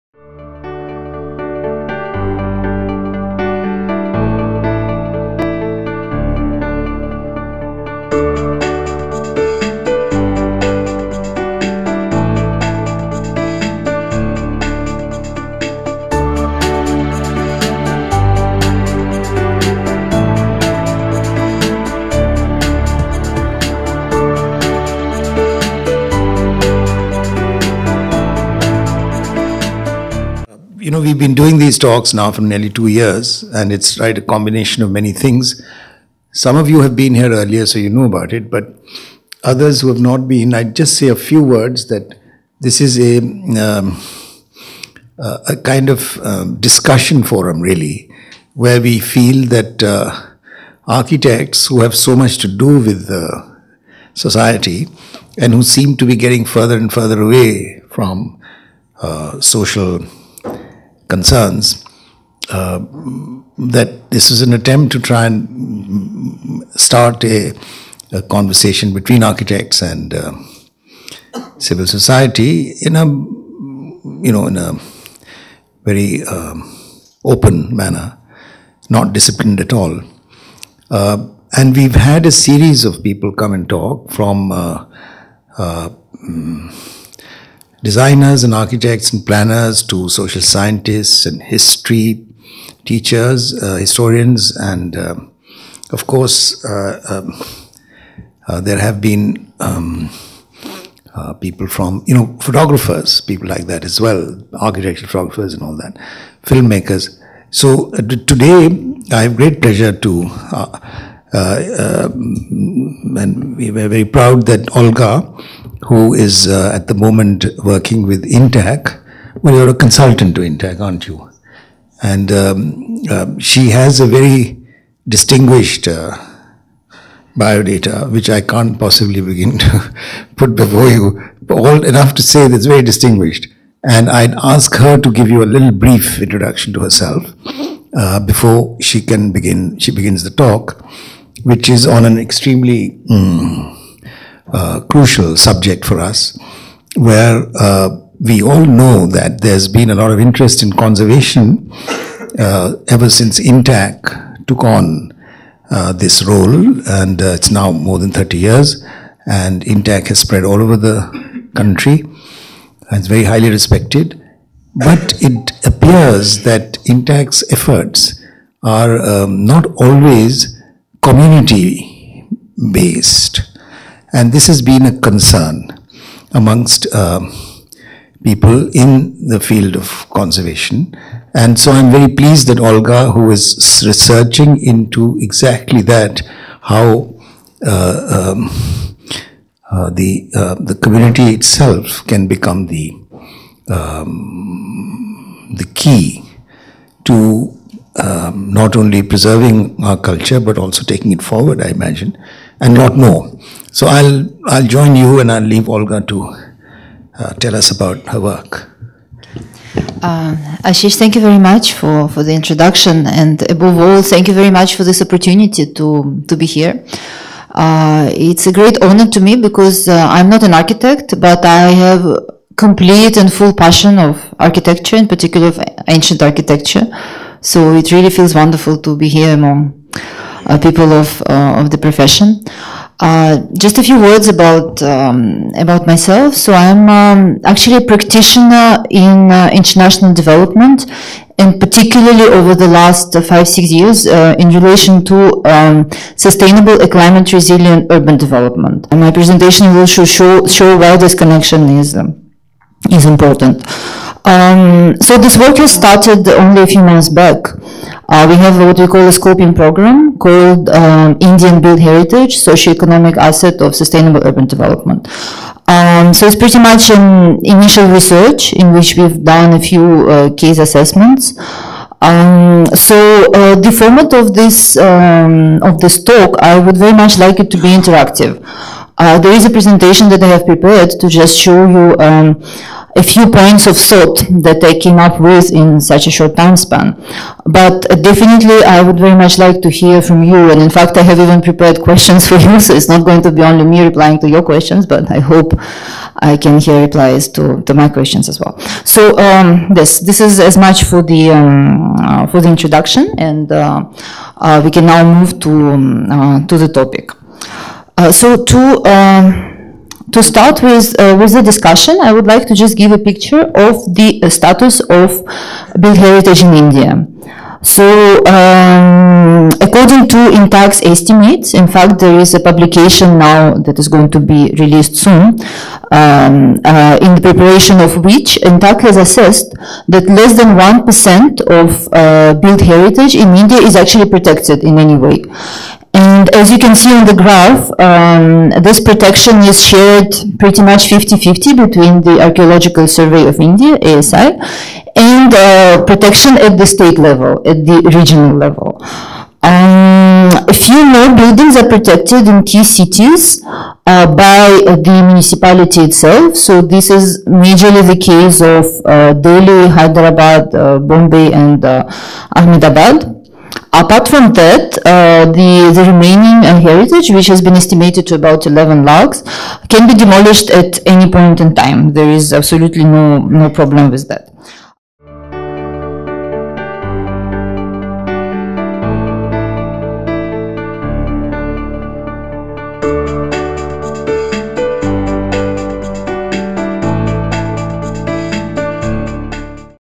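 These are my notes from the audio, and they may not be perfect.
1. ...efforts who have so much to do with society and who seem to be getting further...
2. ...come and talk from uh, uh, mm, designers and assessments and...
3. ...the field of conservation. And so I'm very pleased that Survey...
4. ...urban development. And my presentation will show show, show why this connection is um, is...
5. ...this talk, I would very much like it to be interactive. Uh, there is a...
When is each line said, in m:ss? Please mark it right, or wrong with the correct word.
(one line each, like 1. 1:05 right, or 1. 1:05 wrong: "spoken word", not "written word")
1. 0:50 wrong: "architects", not "efforts"
2. 1:23 wrong: "architects", not "assessments"
3. 2:59 wrong: "Olga", not "Survey"
4. 4:07 right
5. 4:35 right.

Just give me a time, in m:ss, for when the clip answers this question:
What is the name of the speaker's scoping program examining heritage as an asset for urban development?
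4:21.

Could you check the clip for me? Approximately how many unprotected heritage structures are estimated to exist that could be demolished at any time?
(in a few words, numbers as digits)
11 lakhs.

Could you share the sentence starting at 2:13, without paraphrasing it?
And I'd ask her to give you a little brief introduction to herself uh, before she can begin.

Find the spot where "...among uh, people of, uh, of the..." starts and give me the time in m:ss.
3:49.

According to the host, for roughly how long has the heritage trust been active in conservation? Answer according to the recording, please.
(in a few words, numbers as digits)
more than 30 years.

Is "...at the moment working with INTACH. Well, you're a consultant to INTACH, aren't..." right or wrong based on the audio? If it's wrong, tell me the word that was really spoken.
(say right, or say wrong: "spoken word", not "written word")
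right.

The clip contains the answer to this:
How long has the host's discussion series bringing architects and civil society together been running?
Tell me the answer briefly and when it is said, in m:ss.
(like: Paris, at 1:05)
nearly two years, at 0:32.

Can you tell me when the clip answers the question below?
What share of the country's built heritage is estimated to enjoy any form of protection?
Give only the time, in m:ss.
5:30.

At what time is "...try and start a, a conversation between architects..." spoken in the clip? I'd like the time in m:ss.
1:05.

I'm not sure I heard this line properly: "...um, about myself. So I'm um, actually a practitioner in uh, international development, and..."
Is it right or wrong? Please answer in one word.
right.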